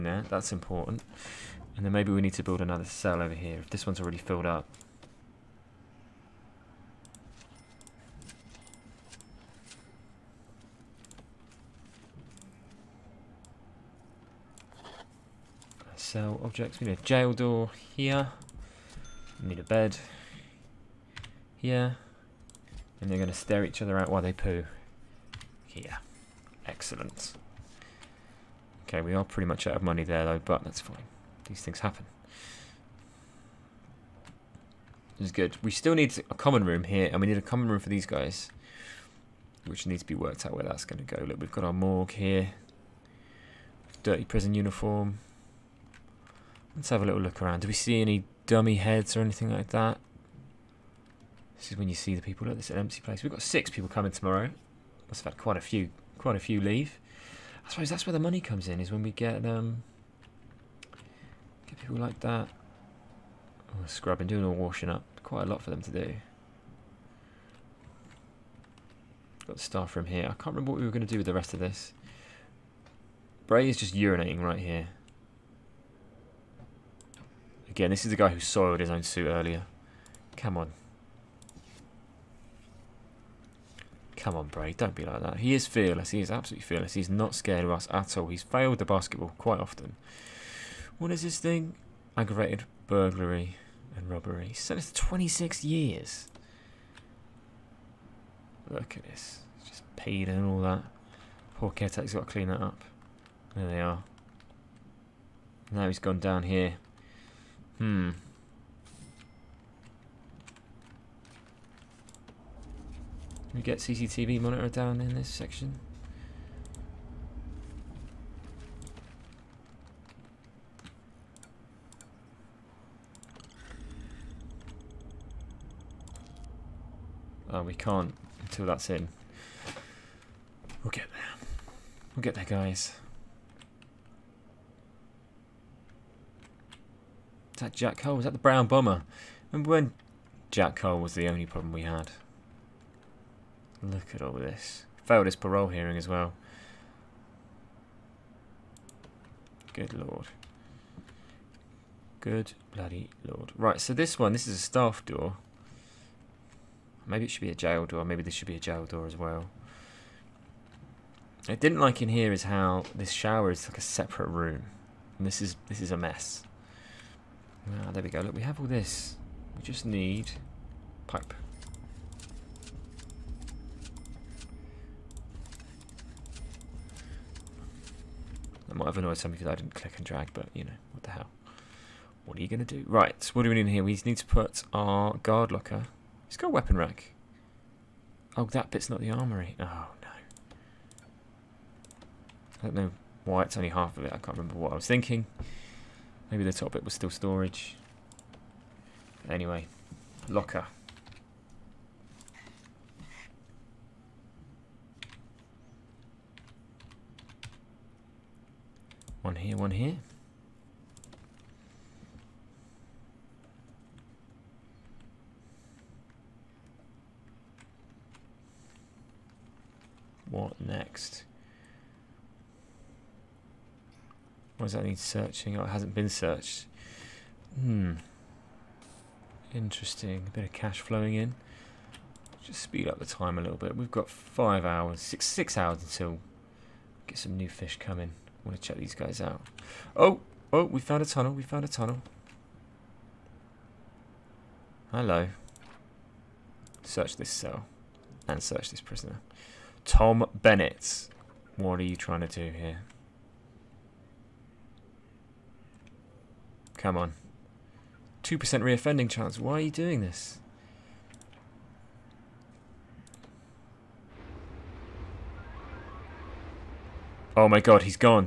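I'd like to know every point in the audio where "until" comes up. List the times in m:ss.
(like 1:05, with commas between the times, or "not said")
2:08, 3:55.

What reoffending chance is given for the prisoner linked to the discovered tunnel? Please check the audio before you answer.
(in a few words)
2%.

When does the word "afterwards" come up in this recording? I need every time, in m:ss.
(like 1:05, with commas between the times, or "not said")
not said.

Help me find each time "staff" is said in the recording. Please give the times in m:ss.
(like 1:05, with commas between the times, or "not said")
1:09, 2:34.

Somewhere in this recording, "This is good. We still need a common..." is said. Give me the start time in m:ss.
0:35.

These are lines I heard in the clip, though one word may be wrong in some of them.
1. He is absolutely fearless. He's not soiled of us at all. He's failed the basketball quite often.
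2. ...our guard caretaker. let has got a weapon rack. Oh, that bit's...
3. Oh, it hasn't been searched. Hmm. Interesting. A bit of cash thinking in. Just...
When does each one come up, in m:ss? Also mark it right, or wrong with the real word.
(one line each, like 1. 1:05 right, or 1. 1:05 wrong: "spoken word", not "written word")
1. 1:26 wrong: "scared", not "soiled"
2. 3:04 wrong: "locker", not "caretaker"
3. 3:45 wrong: "flowing", not "thinking".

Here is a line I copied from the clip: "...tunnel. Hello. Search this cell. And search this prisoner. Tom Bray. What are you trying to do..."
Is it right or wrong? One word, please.
wrong.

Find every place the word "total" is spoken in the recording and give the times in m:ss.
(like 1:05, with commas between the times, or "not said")
not said.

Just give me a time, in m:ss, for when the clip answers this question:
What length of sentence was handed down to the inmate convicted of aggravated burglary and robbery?
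1:35.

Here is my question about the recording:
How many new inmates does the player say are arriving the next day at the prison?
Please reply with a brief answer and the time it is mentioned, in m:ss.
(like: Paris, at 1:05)
6, at 0:53.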